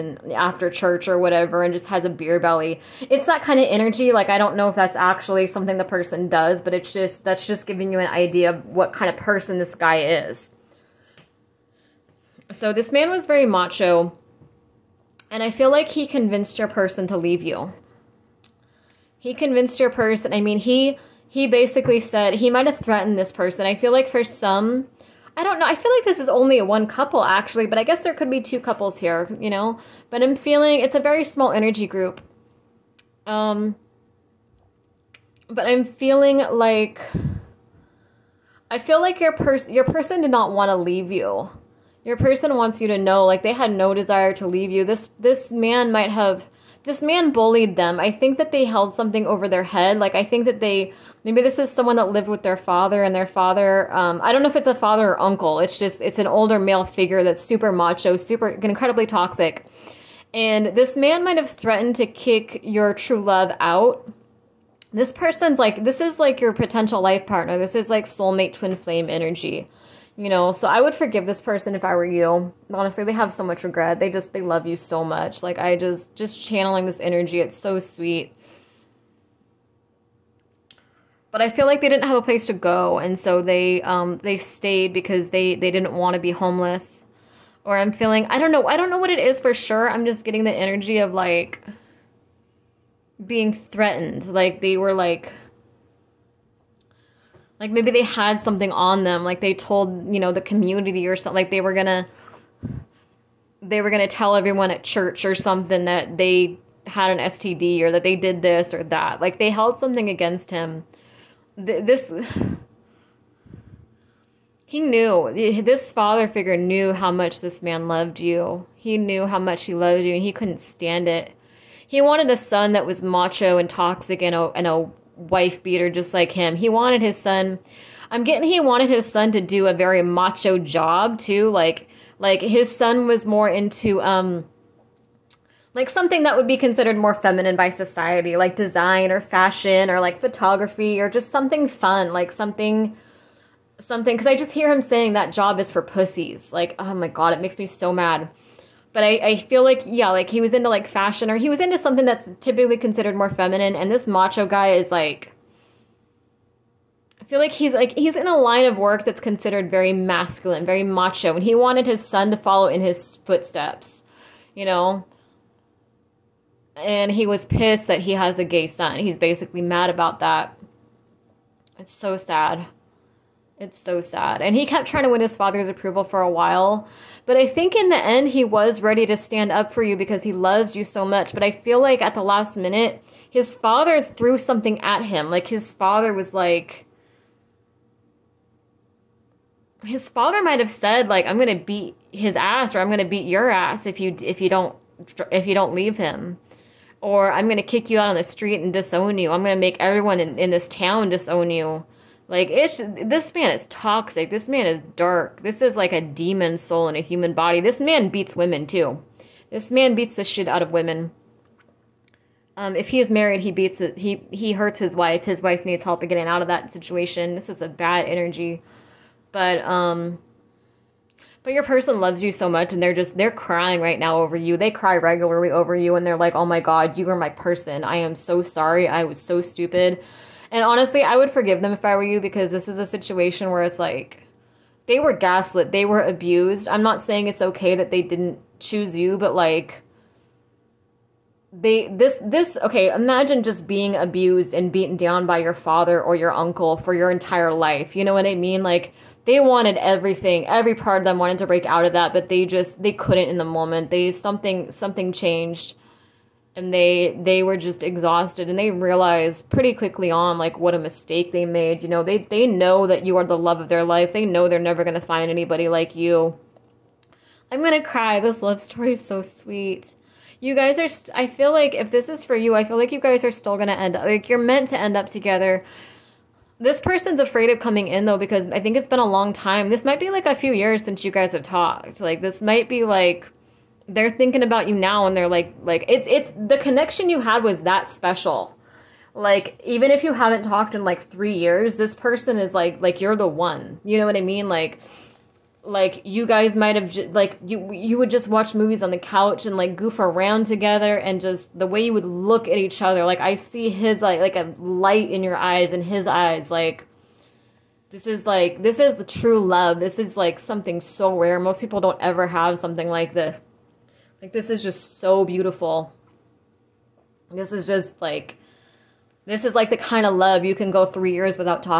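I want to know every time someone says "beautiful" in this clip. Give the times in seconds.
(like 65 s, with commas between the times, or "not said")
315 s.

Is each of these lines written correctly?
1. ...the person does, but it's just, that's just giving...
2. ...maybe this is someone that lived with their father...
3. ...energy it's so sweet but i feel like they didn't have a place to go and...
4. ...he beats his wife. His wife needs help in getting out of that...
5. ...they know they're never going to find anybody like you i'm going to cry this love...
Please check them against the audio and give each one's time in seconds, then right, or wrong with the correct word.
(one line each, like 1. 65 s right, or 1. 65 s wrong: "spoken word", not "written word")
1. 5 s right
2. 51 s right
3. 77 s right
4. 214 s wrong: "hurts", not "beats"
5. 264 s right.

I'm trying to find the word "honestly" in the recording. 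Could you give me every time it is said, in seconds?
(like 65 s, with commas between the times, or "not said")
72 s, 230 s.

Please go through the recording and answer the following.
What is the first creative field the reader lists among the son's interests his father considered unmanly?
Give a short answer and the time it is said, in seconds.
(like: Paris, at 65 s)
Design, at 138 s.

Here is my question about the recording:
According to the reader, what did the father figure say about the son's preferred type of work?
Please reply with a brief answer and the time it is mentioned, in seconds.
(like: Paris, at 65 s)
That job is for pussies, at 145 s.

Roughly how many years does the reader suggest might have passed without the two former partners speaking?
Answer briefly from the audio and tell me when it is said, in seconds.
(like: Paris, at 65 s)
3 years, at 291 s.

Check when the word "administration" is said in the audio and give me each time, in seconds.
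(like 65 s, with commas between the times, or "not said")
not said.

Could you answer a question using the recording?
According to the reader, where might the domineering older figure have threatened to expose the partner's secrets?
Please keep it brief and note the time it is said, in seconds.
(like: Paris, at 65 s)
At church, at 104 s.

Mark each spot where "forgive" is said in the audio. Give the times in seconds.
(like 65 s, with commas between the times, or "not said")
70 s, 231 s.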